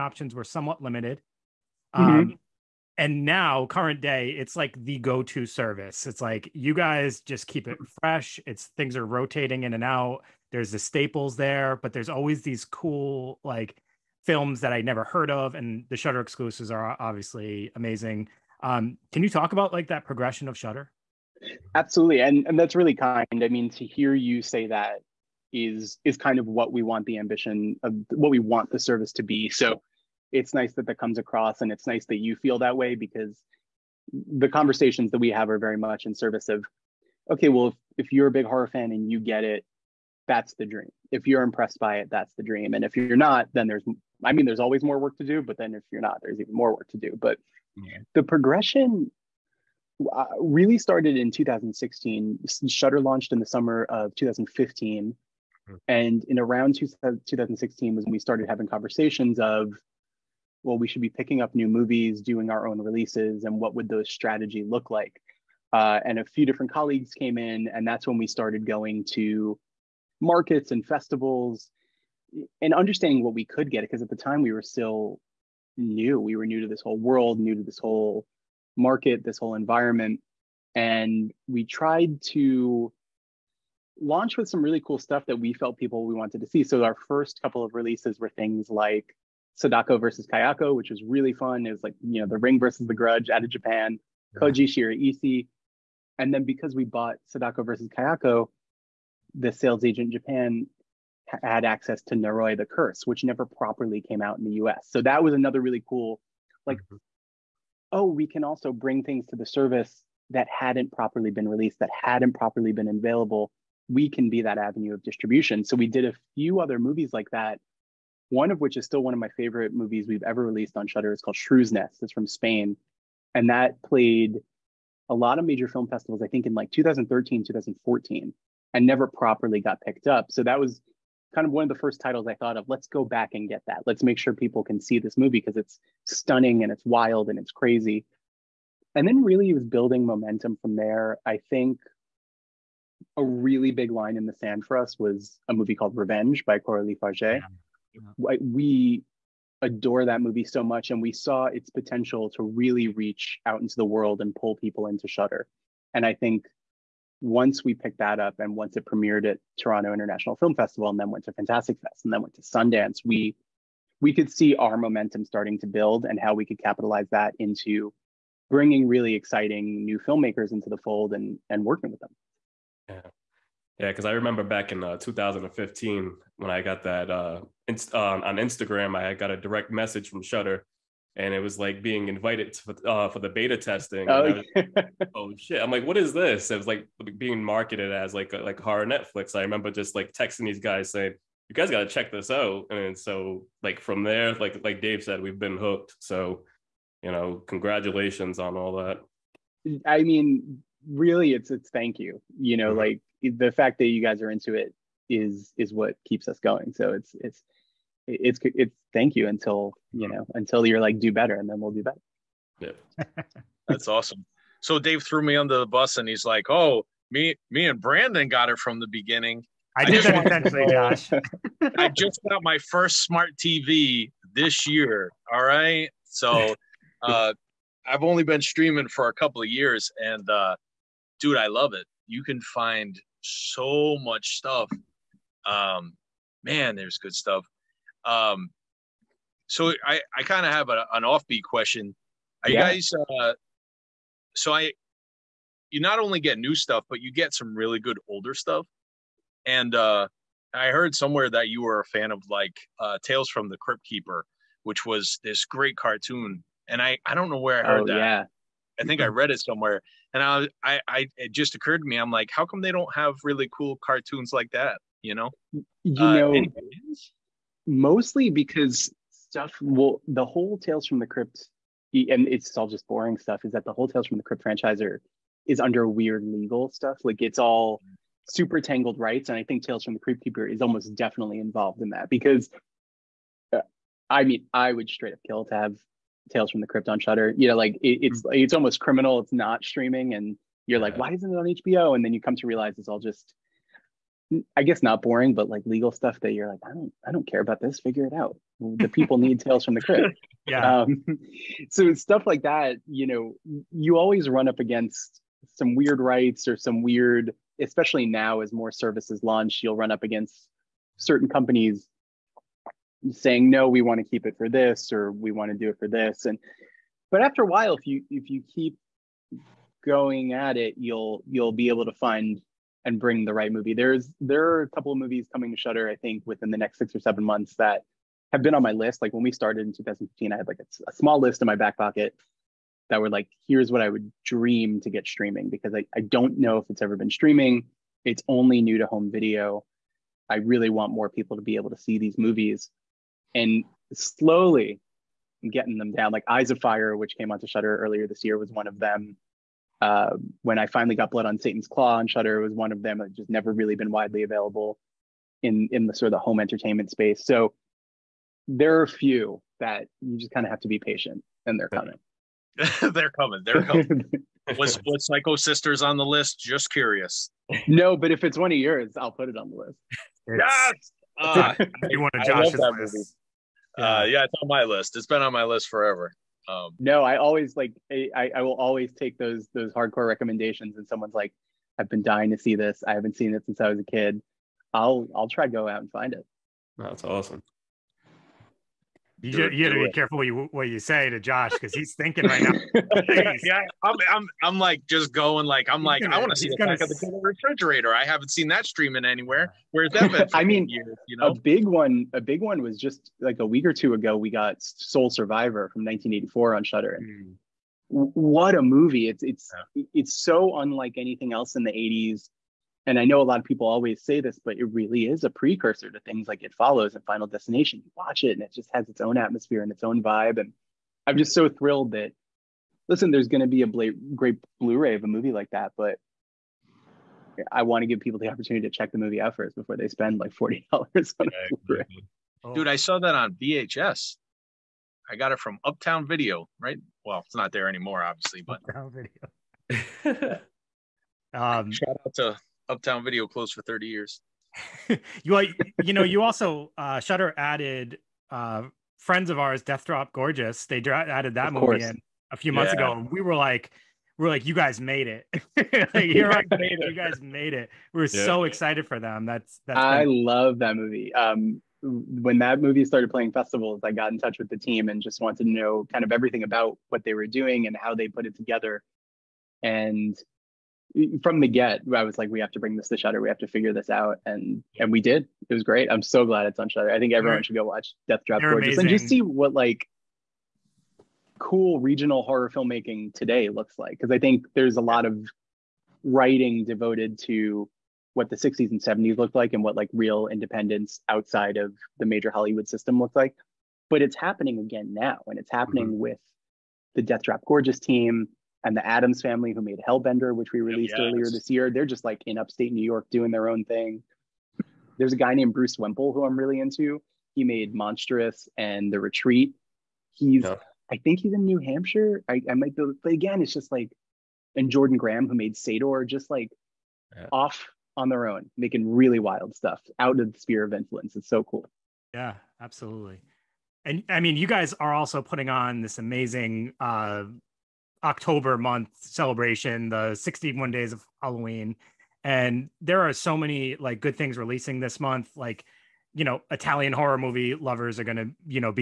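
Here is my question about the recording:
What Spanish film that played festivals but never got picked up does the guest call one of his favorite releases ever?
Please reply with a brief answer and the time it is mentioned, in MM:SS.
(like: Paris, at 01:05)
Shrew's Nest, at 02:01.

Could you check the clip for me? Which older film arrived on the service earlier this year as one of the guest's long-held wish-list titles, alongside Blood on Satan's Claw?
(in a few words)
Eyes of Fire.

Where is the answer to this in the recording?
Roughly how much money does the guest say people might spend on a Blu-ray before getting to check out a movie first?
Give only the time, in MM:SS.
07:10.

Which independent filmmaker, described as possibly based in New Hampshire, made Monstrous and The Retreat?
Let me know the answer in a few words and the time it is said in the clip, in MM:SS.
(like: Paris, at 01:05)
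Bruce Wemple, at 08:25.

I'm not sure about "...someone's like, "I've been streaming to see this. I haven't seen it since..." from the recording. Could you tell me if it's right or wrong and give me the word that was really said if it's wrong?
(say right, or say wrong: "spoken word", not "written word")
wrong: "dying", not "streaming".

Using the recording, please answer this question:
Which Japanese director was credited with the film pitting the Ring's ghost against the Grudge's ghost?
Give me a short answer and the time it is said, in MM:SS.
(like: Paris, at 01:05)
Koji Shiraishi, at 01:34.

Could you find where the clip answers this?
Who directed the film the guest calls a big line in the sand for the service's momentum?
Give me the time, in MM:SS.
02:26.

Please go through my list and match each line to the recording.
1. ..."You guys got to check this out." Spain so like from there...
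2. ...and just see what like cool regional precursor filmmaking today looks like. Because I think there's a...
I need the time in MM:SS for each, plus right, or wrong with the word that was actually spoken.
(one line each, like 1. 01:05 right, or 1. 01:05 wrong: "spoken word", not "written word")
1. 03:11 wrong: "And", not "Spain"
2. 07:58 wrong: "horror", not "precursor".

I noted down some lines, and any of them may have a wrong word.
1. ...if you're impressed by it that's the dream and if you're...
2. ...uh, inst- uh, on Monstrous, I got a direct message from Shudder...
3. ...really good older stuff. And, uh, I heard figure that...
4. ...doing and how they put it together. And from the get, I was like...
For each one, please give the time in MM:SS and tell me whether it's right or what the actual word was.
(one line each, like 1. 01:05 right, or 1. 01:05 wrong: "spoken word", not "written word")
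1. 00:41 right
2. 02:57 wrong: "Instagram", not "Monstrous"
3. 04:07 wrong: "somewhere", not "figure"
4. 07:47 right.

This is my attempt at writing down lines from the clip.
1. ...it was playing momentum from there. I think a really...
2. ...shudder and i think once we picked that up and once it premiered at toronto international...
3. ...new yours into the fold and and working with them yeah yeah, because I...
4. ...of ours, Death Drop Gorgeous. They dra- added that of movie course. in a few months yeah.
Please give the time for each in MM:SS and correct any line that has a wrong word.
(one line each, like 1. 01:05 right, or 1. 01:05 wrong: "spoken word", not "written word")
1. 02:19 wrong: "building", not "playing"
2. 02:35 right
3. 02:49 wrong: "filmmakers", not "yours"
4. 07:29 right.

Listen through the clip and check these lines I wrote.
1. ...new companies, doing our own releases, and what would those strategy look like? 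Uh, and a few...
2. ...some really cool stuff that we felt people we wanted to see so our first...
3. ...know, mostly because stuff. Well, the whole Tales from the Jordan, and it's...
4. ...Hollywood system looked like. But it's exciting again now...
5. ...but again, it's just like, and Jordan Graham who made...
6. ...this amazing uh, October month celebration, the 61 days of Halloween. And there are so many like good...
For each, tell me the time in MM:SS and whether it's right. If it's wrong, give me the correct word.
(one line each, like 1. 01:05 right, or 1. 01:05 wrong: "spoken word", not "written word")
1. 01:01 wrong: "movies", not "companies"
2. 01:24 right
3. 04:26 wrong: "Crypt", not "Jordan"
4. 08:12 wrong: "happening", not "exciting"
5. 08:33 right
6. 08:45 right.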